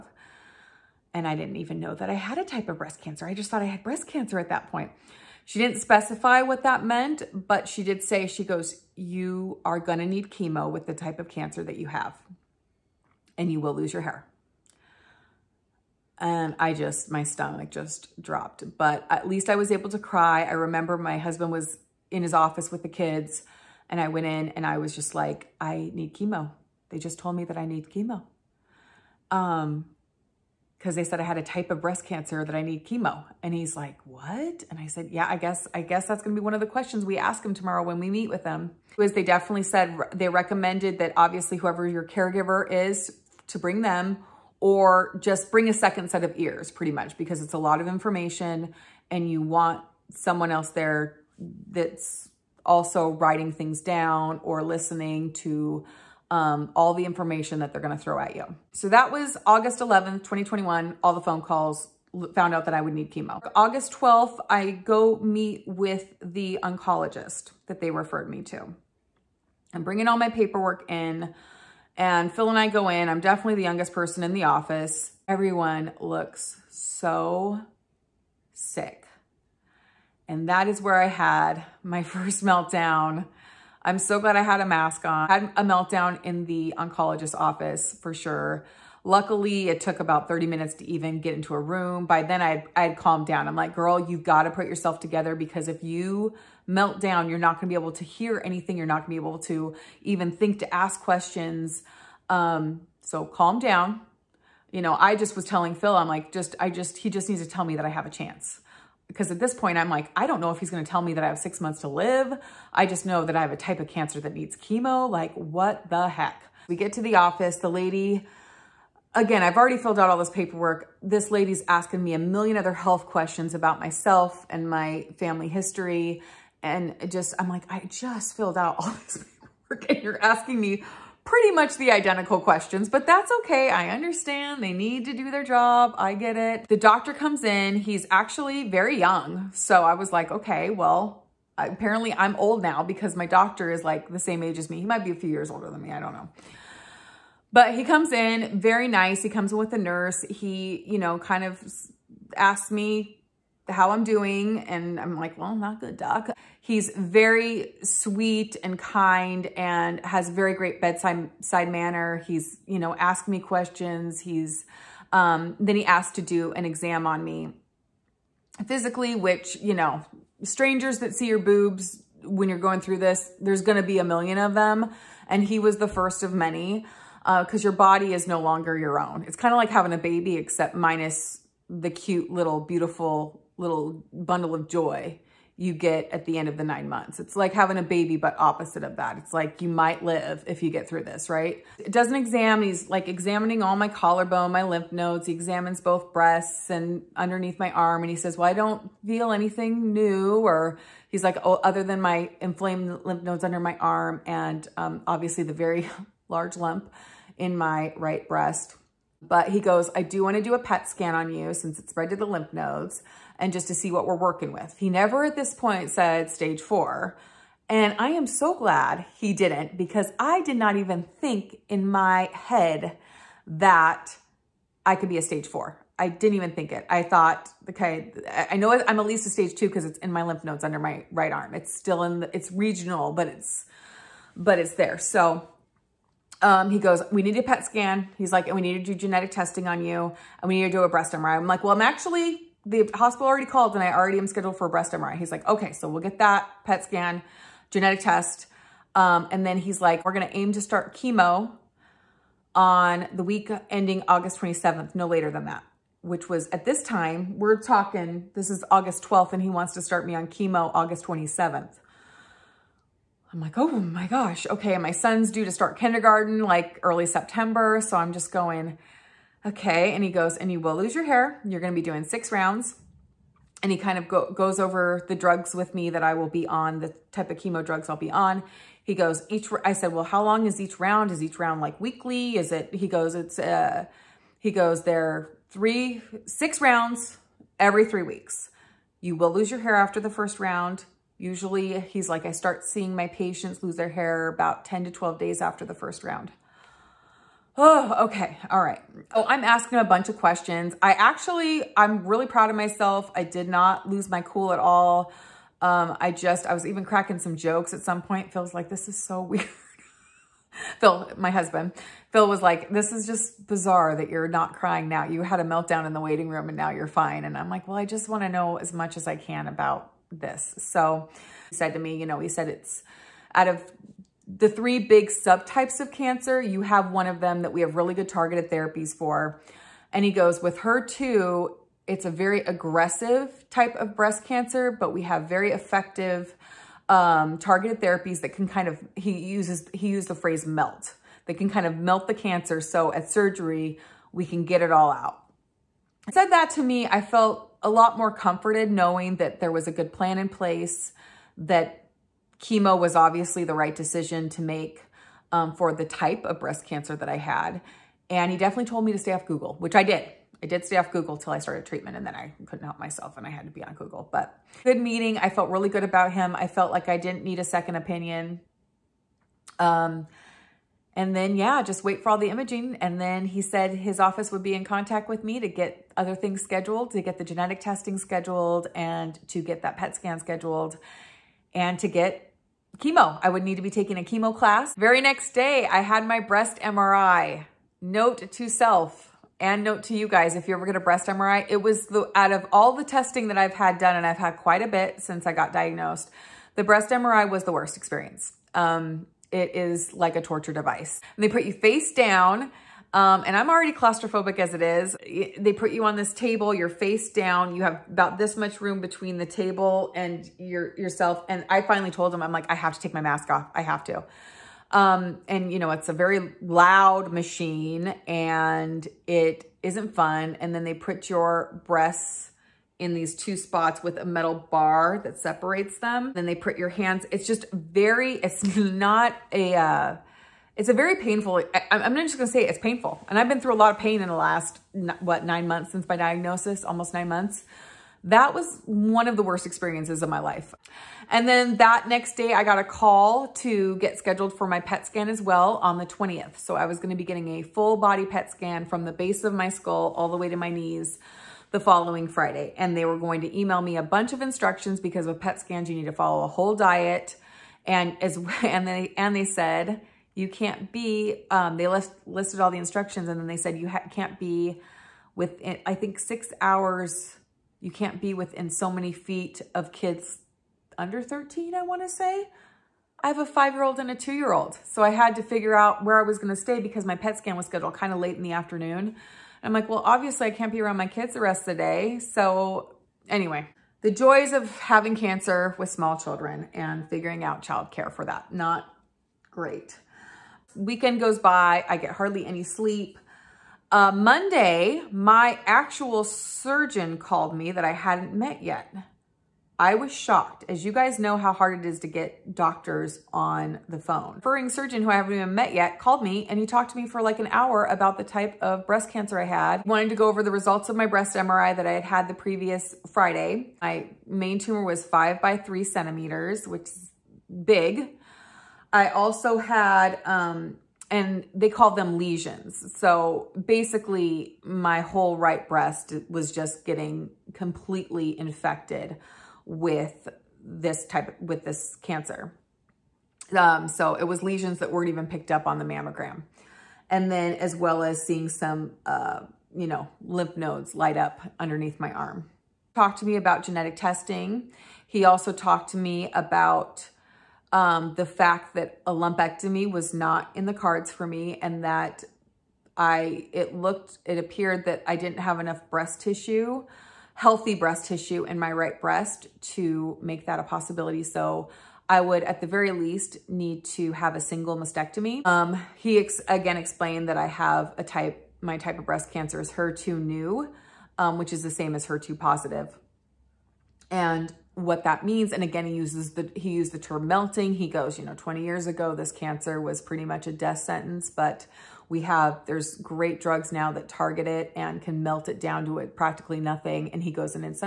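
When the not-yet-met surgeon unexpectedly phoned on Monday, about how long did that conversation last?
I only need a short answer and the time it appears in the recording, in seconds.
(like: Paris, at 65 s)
An hour, at 507 s.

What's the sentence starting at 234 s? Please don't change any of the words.
So um, he goes, we need a PET scan.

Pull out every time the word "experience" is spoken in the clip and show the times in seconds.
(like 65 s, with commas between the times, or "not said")
397 s, 439 s.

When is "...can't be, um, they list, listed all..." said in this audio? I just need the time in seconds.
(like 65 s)
460 s.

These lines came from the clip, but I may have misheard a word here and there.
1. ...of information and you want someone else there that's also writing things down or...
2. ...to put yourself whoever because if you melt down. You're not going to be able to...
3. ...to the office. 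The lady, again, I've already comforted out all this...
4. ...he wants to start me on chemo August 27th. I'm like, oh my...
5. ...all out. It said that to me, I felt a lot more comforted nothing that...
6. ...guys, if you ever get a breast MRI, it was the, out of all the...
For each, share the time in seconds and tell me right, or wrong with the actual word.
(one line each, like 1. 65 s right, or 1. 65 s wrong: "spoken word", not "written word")
1. 47 s right
2. 94 s wrong: "together", not "whoever"
3. 116 s wrong: "filled", not "comforted"
4. 259 s right
5. 344 s wrong: "knowing", not "nothing"
6. 390 s right.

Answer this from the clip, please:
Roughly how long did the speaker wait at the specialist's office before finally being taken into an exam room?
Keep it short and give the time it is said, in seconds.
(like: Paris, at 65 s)
30 minutes, at 90 s.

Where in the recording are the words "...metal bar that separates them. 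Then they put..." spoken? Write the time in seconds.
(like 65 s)
424 s.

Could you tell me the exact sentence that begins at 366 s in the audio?
I felt like I didn't need a second opinion.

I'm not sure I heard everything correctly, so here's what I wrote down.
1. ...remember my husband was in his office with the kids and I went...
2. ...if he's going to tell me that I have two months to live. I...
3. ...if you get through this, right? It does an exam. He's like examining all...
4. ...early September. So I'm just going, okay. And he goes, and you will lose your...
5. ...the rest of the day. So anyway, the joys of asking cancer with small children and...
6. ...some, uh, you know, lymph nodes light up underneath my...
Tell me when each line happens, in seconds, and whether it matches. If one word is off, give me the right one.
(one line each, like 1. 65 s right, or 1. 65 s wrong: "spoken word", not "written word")
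1. 20 s right
2. 110 s wrong: "six", not "two"
3. 190 s right
4. 266 s right
5. 481 s wrong: "having", not "asking"
6. 538 s right.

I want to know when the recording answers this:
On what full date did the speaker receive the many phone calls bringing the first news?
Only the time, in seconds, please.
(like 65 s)
59 s.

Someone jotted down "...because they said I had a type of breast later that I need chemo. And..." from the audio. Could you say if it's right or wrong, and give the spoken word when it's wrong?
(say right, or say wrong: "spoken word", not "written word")
wrong: "cancer", not "later".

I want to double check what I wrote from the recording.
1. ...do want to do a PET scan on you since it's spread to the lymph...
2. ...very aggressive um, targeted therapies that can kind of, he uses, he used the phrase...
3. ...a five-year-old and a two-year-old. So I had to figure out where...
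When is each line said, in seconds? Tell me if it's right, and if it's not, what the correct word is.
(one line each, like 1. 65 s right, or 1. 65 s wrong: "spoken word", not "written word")
1. 210 s right
2. 335 s wrong: "effective", not "aggressive"
3. 473 s right.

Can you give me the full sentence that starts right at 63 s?
August 12th, I go meet with the oncologist that they referred me to.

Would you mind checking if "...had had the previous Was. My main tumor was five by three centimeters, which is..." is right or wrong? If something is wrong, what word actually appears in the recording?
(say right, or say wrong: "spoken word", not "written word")
wrong: "Friday", not "Was".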